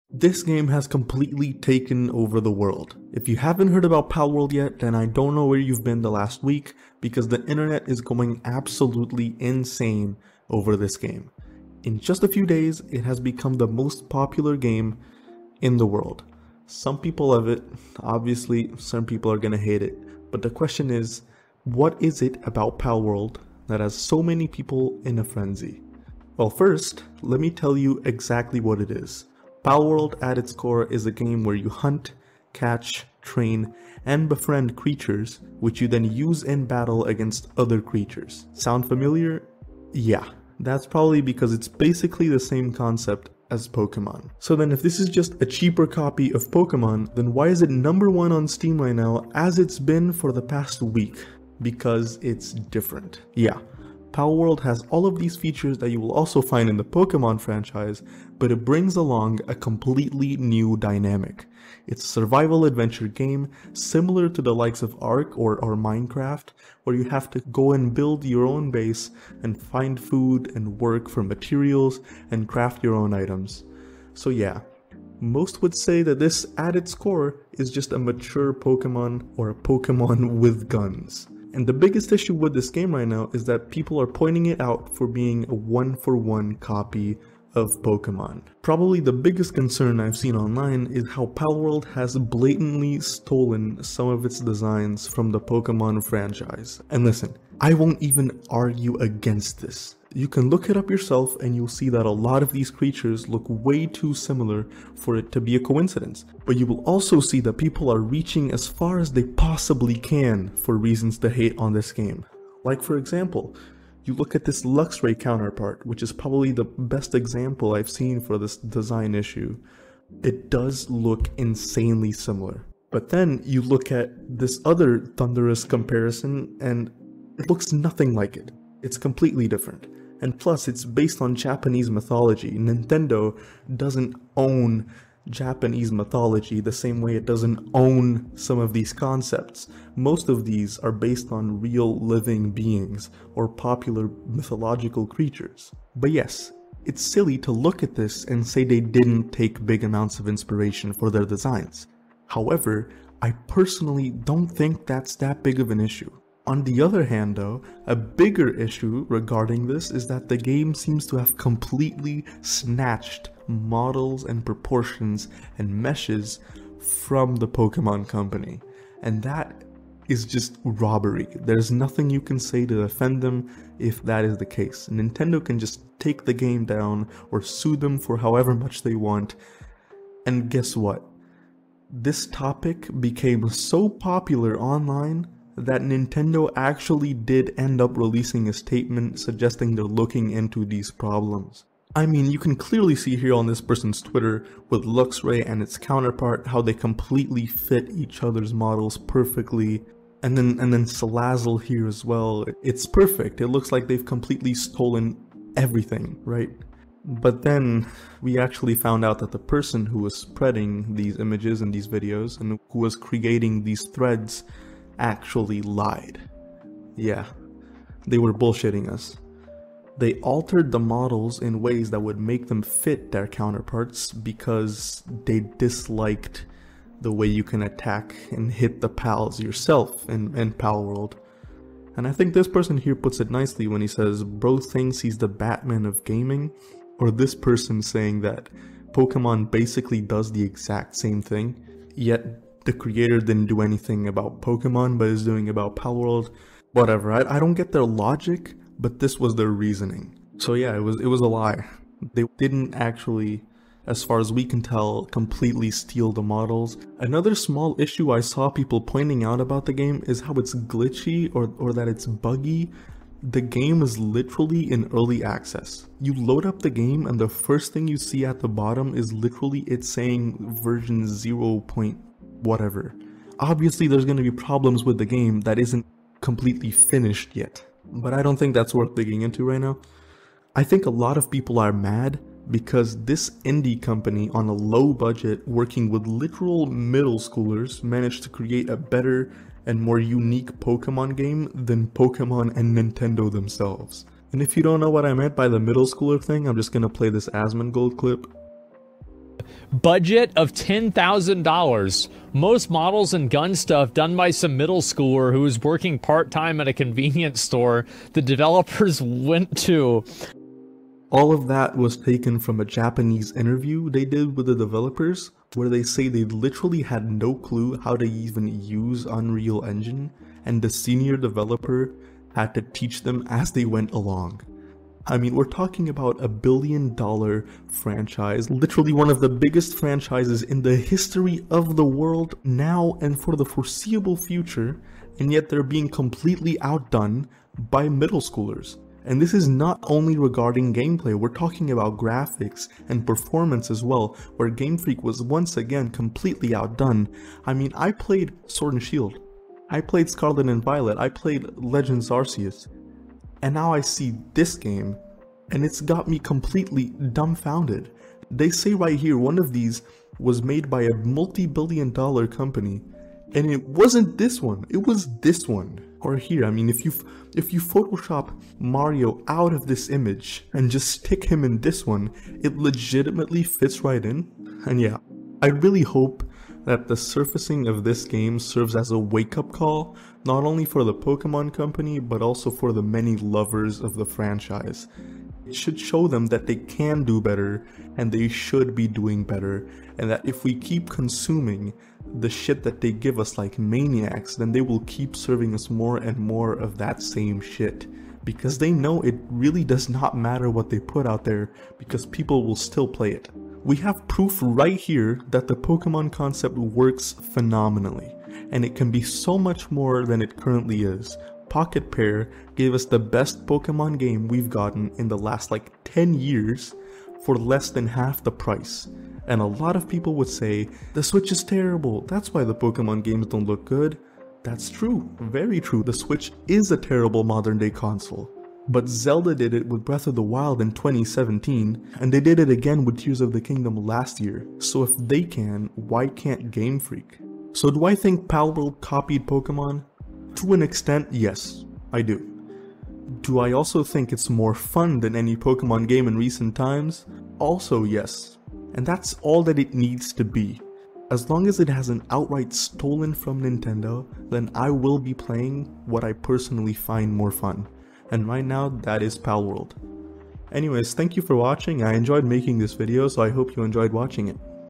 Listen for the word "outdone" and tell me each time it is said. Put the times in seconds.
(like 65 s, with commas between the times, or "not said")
336 s, 346 s.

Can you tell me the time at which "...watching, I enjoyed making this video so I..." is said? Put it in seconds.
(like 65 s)
461 s.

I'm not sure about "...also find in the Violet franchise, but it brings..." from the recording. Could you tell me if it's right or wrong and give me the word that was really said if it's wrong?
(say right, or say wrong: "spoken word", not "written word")
wrong: "Pokemon", not "Violet".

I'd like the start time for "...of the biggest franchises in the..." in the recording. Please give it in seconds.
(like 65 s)
329 s.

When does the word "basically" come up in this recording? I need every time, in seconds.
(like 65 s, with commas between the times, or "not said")
41 s, 239 s.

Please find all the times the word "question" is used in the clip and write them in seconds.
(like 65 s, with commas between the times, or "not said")
20 s.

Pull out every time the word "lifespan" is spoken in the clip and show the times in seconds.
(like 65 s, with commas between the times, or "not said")
not said.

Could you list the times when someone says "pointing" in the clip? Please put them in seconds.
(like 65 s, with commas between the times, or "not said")
84 s, 258 s.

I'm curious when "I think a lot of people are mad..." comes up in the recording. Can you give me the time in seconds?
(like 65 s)
280 s.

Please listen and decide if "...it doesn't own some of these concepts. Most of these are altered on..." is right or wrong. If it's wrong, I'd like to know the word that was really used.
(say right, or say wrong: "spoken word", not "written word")
wrong: "based", not "altered".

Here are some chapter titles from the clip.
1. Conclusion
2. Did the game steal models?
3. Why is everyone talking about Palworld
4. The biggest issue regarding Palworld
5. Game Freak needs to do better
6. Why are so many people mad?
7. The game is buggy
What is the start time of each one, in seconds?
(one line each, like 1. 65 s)
1. 375 s
2. 162 s
3. 44 s
4. 88 s
5. 346 s
6. 283 s
7. 257 s.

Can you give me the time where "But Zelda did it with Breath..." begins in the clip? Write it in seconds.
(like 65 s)
428 s.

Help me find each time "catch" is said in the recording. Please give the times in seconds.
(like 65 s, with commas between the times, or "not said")
32 s.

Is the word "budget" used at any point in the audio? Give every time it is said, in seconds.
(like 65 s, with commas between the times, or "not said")
284 s, 299 s.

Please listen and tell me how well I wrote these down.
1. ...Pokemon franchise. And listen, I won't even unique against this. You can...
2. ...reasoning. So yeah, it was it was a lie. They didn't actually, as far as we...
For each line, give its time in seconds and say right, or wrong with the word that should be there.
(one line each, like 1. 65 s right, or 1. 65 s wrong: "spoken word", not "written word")
1. 95 s wrong: "argue", not "unique"
2. 249 s right.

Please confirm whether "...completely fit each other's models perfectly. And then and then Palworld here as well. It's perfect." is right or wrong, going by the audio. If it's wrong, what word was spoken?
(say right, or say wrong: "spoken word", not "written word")
wrong: "Salazzle", not "Palworld".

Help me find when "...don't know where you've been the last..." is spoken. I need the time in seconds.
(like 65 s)
5 s.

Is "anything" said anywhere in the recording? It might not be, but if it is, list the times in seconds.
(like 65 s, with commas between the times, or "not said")
243 s.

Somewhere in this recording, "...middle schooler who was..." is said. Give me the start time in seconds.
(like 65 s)
304 s.